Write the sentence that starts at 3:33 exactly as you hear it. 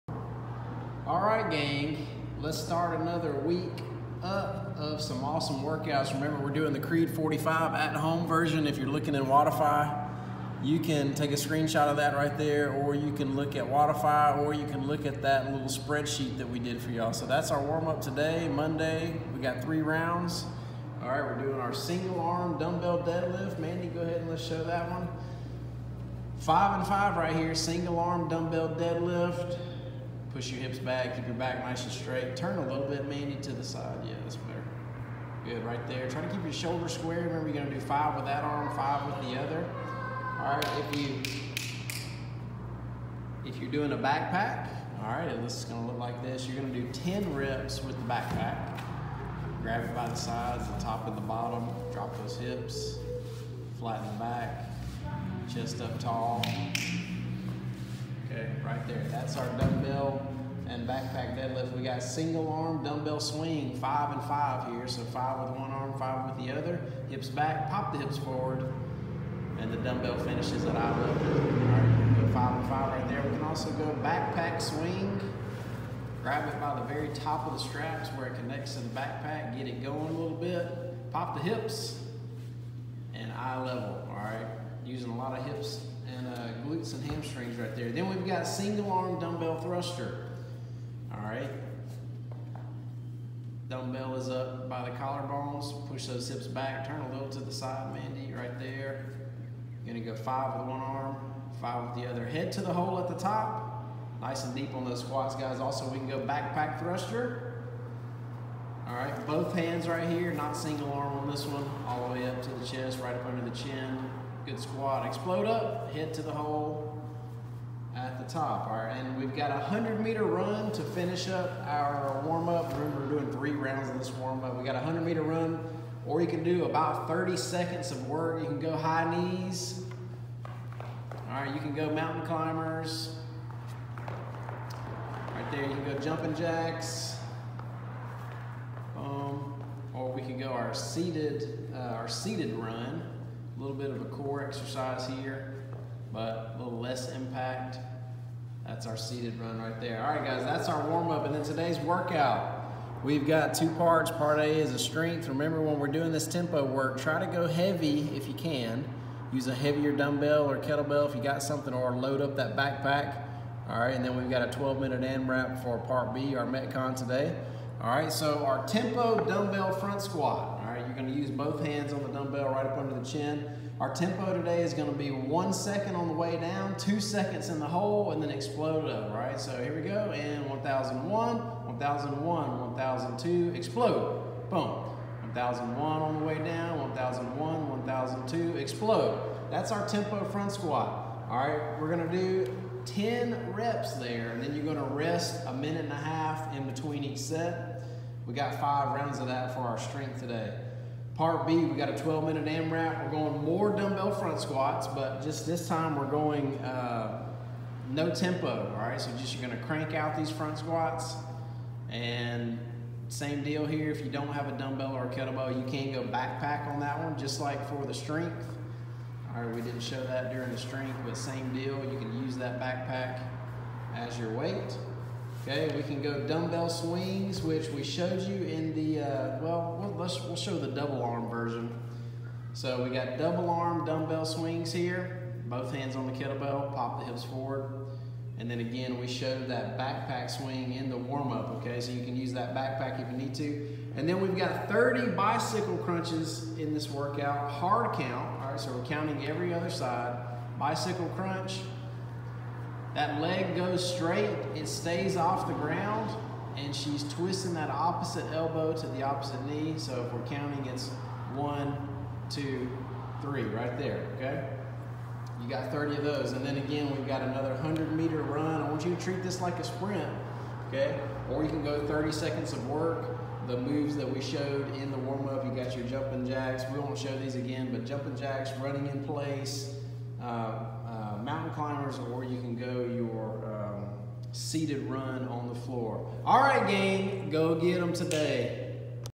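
If you don't have a dumbbell or a kettlebell, you can go backpack on that one, just like for the strength.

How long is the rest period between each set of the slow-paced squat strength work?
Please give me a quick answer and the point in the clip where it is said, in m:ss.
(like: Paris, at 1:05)
a minute and a half, at 3:15.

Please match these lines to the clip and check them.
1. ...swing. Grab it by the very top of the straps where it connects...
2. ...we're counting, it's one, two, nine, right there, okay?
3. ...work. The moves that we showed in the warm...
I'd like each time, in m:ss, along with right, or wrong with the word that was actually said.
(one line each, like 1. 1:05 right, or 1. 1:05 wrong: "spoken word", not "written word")
1. 1:14 right
2. 4:20 wrong: "three", not "nine"
3. 4:32 right.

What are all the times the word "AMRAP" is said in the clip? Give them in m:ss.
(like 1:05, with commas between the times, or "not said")
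2:45, 3:22.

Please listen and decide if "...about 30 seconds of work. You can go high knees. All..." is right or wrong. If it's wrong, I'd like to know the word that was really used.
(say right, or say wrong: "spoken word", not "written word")
right.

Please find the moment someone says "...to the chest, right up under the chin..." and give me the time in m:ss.
1:52.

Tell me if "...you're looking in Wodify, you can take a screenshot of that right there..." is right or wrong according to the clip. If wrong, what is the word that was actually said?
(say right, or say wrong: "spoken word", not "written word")
right.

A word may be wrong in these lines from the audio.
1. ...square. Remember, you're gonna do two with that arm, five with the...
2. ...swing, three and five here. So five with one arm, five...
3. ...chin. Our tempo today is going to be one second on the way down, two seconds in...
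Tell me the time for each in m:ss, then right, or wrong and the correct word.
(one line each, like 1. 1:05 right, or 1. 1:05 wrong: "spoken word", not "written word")
1. 0:36 wrong: "five", not "two"
2. 1:03 wrong: "five", not "three"
3. 2:53 right.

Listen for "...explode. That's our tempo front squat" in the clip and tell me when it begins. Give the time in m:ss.
3:08.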